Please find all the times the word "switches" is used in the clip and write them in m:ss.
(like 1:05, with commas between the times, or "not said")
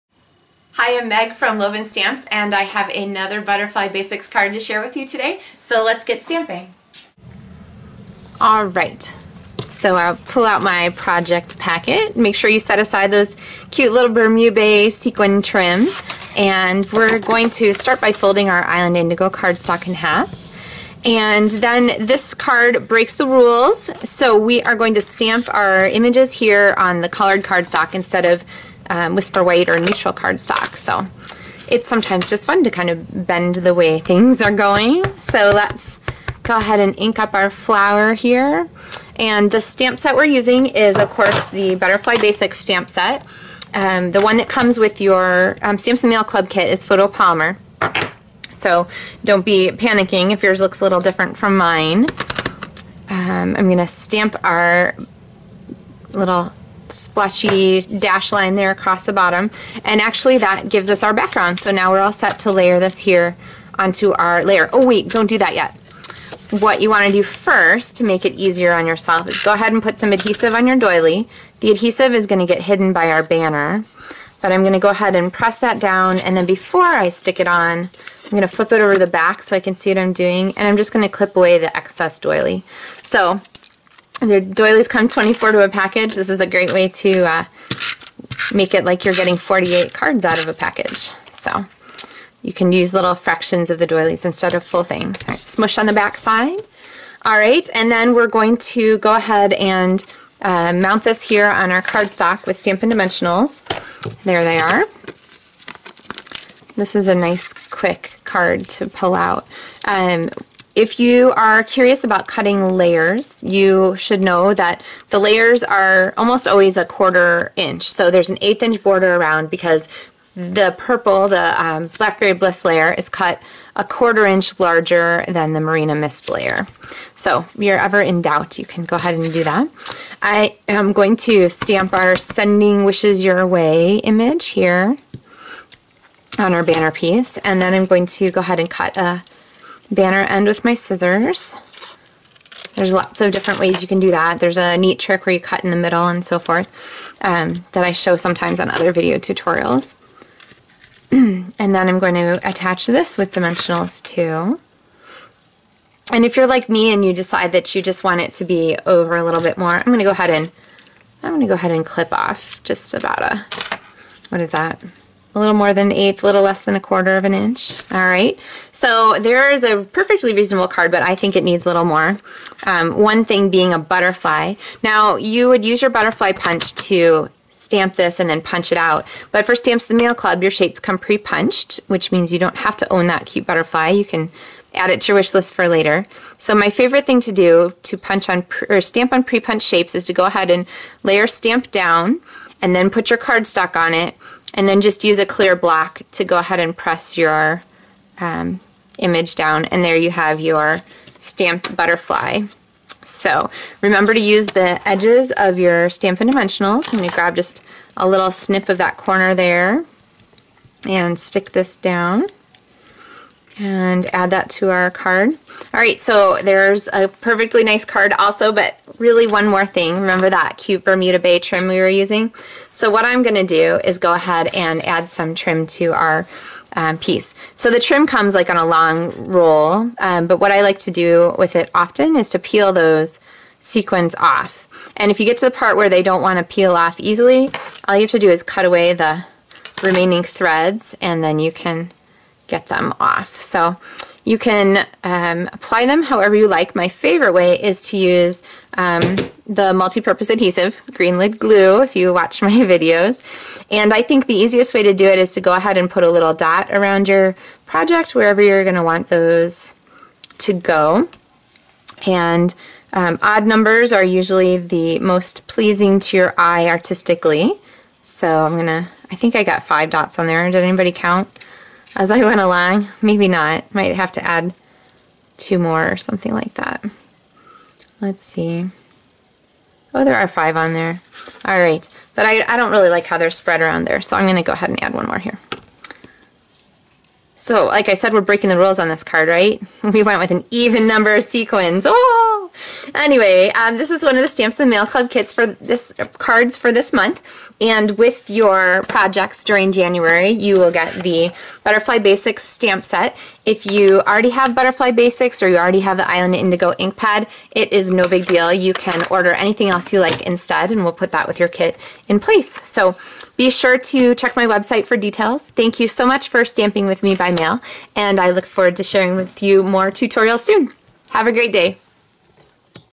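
not said.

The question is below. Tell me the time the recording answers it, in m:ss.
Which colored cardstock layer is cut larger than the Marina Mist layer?
2:01.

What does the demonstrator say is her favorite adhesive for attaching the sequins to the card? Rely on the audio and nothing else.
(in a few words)
Multi-purpose adhesive.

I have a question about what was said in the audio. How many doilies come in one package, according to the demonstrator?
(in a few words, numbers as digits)
24.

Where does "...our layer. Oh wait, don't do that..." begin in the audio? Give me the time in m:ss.
1:04.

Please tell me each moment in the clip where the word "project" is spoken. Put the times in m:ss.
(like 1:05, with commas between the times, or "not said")
0:10, 4:17, 4:58.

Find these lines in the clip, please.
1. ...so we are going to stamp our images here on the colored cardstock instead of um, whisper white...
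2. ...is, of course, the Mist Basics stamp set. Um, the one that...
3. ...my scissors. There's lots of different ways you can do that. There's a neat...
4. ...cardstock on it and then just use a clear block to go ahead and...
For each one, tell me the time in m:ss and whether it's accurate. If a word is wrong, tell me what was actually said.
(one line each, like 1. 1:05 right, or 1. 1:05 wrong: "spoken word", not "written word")
1. 0:24 right
2. 0:40 wrong: "Butterfly", not "Mist"
3. 2:20 right
4. 3:13 right.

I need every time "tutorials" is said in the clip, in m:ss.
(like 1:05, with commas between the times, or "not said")
2:29, 5:19.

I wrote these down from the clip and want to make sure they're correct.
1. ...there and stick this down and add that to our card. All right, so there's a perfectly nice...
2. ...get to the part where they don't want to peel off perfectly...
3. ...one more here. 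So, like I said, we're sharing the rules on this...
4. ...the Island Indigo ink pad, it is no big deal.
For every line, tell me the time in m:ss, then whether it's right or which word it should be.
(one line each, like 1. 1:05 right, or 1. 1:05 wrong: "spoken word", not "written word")
1. 3:29 right
2. 3:55 wrong: "easily", not "perfectly"
3. 4:44 wrong: "breaking", not "sharing"
4. 5:05 right.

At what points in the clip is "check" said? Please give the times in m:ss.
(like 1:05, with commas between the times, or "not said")
5:14.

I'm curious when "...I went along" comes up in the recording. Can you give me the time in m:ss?
4:32.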